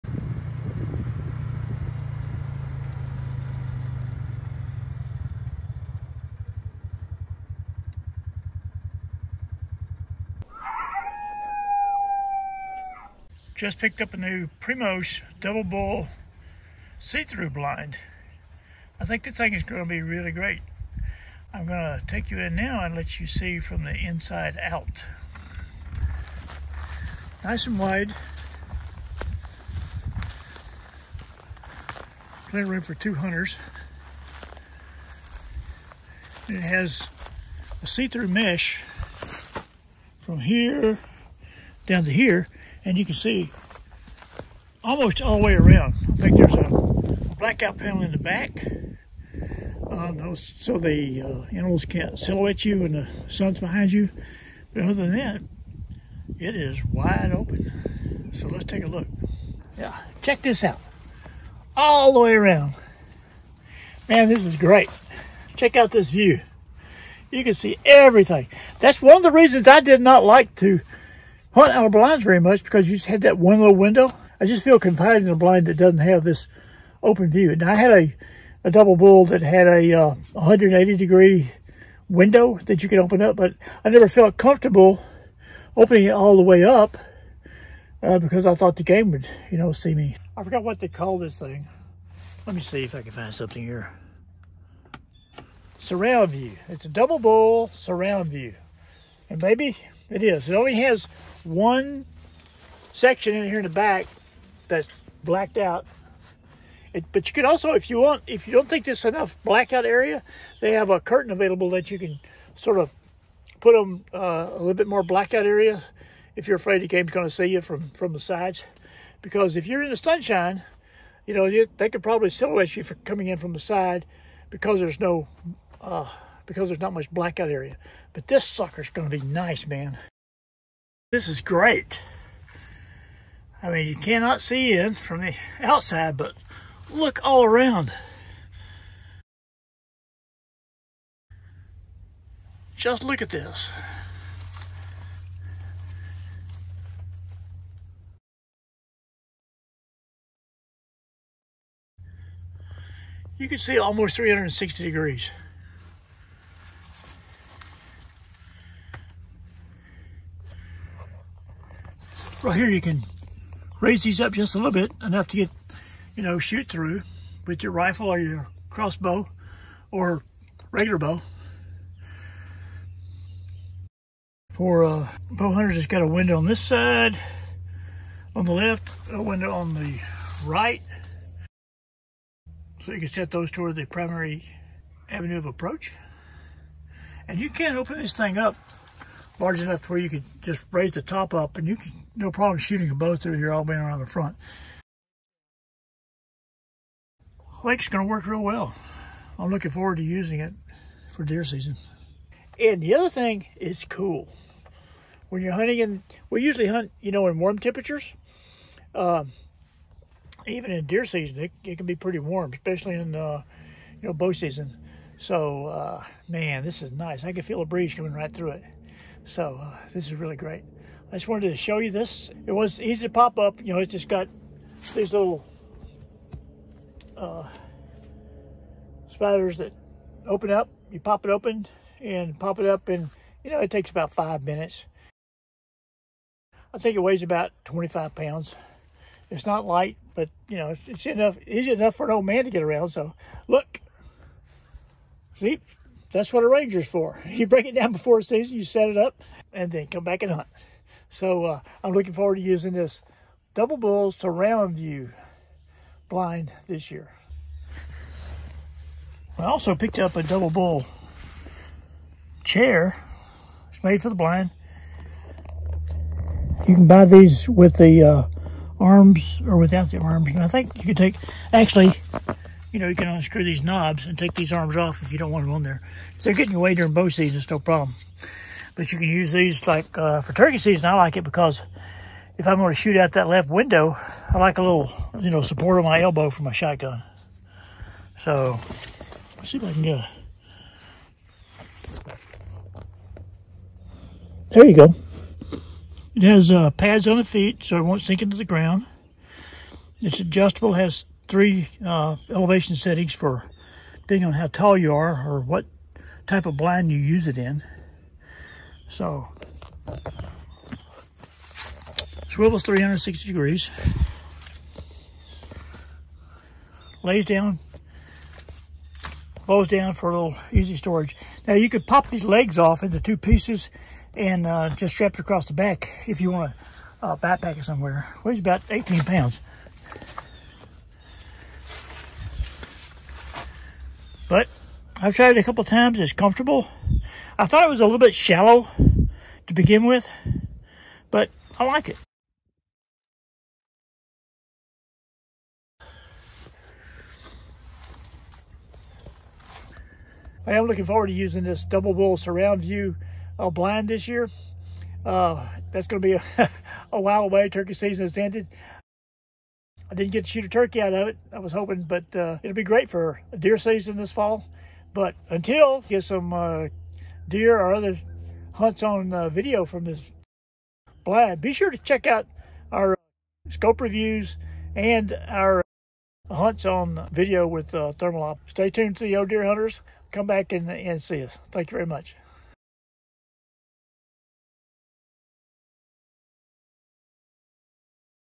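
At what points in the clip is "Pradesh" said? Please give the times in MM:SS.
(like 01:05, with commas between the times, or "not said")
not said.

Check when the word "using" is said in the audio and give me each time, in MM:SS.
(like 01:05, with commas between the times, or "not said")
03:20, 04:12, 05:51.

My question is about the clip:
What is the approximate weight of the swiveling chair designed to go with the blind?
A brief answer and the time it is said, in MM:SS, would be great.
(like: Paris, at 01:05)
18 pounds, at 05:28.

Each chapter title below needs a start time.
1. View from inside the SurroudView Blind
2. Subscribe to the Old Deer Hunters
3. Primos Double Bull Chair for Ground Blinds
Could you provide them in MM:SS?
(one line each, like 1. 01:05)
1. 00:59
2. 05:58
3. 04:15.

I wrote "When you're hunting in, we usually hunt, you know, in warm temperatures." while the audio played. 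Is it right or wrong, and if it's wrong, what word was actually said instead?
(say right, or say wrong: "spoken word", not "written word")
right.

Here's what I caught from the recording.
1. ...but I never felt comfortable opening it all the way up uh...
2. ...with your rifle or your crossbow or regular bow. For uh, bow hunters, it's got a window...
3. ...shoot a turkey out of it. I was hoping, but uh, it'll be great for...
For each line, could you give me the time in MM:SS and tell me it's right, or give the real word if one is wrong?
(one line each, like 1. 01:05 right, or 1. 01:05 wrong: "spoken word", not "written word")
1. 01:23 right
2. 02:47 right
3. 06:00 right.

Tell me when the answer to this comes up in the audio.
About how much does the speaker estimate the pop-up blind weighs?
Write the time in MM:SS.
03:57.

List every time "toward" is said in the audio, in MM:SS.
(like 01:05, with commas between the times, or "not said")
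03:03.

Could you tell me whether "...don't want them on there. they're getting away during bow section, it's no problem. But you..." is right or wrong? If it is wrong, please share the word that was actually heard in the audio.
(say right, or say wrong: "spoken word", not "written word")
wrong: "season", not "section".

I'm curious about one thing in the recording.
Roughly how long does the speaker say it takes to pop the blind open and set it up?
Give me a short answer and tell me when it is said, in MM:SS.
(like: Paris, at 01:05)
5 minutes, at 03:54.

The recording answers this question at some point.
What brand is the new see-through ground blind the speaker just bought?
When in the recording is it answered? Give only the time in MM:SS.
00:14.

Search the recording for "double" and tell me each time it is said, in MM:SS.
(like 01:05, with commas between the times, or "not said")
00:15, 01:18, 01:36, 04:13, 04:20, 05:51.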